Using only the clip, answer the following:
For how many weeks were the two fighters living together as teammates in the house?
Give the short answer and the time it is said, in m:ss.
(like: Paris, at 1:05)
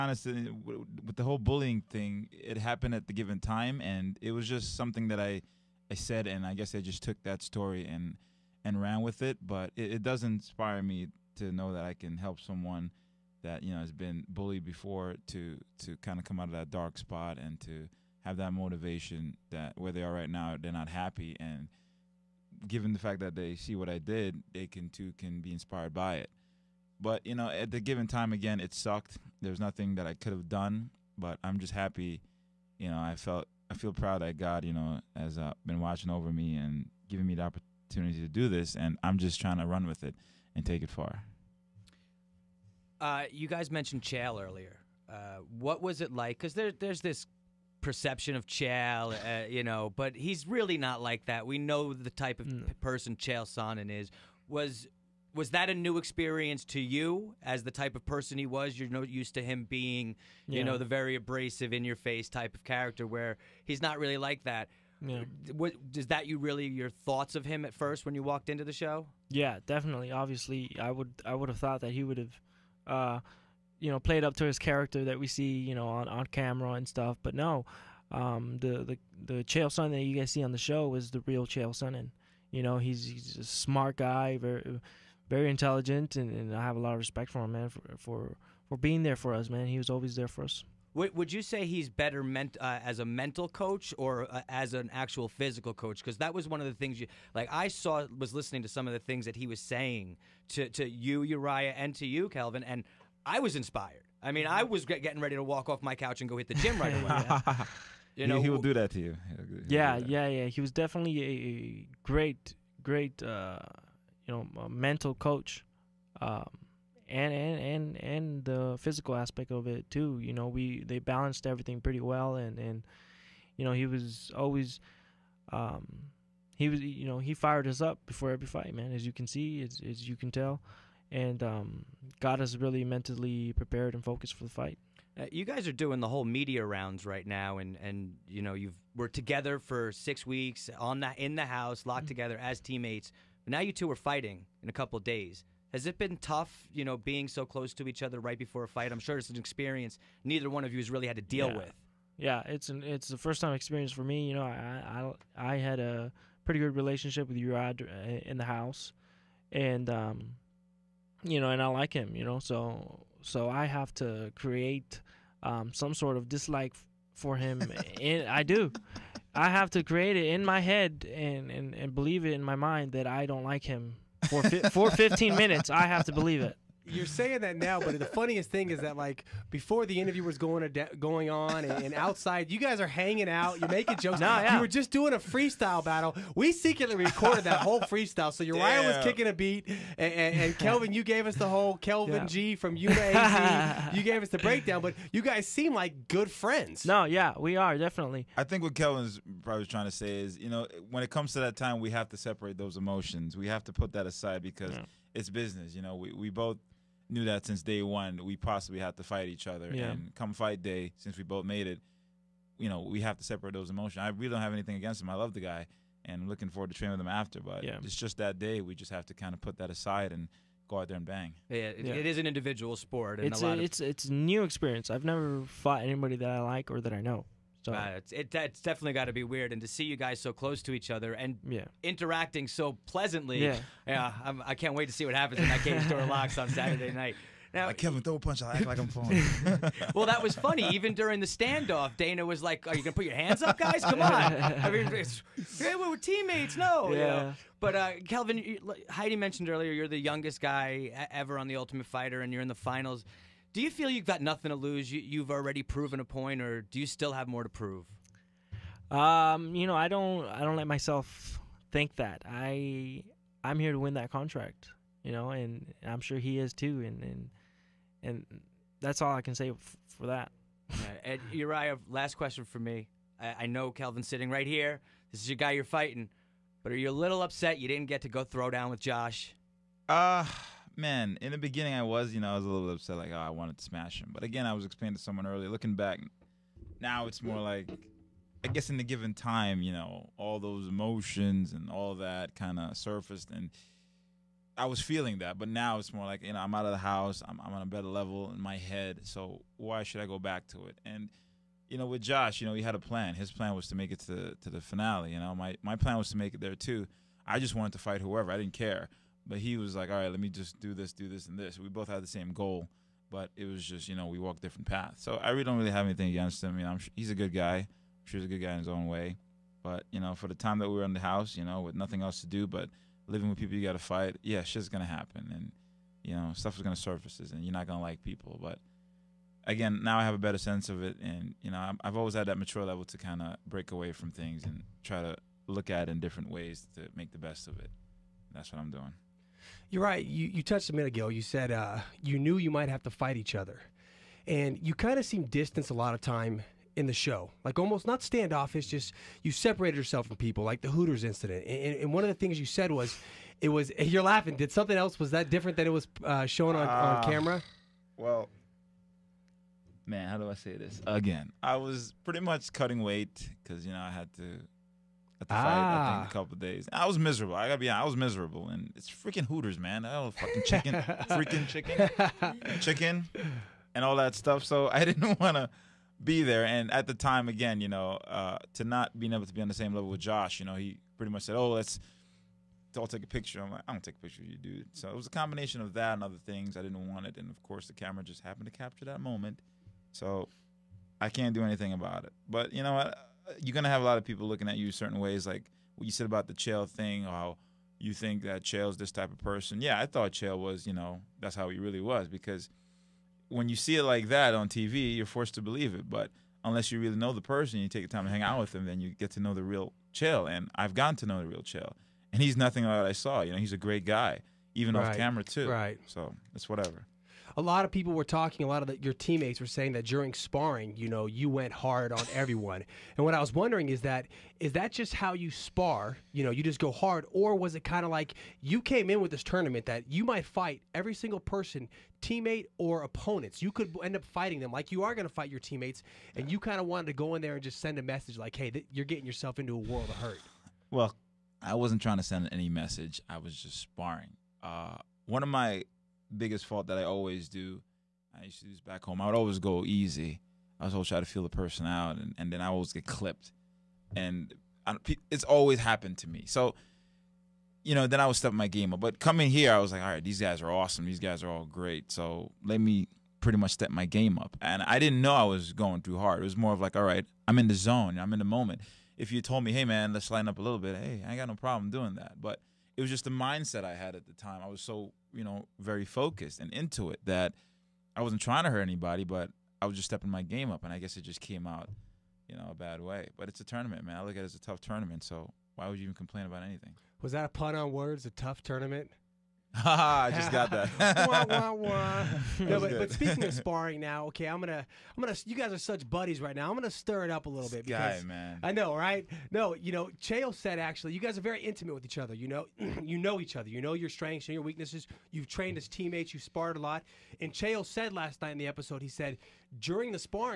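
6, at 2:19.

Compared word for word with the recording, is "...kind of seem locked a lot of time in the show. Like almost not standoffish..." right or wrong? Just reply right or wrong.
wrong.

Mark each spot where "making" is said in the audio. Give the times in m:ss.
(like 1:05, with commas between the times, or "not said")
3:03.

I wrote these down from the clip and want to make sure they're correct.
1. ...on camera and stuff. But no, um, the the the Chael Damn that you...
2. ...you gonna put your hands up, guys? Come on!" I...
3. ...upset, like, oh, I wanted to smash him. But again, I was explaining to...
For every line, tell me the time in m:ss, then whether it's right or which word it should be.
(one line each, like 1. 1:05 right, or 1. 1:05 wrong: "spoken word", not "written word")
1. 1:16 wrong: "Sonnen", not "Damn"
2. 4:02 right
3. 4:42 right.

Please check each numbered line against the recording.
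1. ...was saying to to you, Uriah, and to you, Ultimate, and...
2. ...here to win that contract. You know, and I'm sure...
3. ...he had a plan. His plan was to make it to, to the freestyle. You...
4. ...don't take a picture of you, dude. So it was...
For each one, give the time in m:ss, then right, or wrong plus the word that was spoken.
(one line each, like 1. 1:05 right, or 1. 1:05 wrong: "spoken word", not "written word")
1. 1:39 wrong: "Kelvin", not "Ultimate"
2. 4:23 right
3. 5:02 wrong: "finale", not "freestyle"
4. 6:23 right.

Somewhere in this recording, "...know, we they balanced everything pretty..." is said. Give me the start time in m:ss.
2:00.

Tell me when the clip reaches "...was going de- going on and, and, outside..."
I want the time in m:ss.
3:00.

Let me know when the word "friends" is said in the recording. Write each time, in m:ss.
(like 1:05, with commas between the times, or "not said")
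3:16.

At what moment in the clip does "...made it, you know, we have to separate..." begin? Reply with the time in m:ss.
3:31.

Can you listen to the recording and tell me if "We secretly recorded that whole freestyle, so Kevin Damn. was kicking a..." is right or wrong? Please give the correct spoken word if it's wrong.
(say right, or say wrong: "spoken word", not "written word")
wrong: "Uriah", not "Kevin".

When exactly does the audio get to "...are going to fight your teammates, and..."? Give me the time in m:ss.
7:14.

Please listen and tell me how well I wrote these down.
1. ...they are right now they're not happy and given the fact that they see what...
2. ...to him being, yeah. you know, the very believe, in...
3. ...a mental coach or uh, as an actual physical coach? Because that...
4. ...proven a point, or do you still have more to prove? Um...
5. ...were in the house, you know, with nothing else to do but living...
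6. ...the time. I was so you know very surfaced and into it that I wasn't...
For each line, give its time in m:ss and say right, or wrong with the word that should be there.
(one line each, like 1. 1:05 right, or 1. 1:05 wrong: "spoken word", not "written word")
1. 0:19 right
2. 0:59 wrong: "abrasive", not "believe"
3. 1:32 right
4. 4:15 right
5. 5:20 right
6. 7:54 wrong: "focused", not "surfaced".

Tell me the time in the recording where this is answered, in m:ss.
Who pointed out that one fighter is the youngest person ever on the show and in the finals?
4:08.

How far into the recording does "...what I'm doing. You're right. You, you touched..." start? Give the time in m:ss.
5:38.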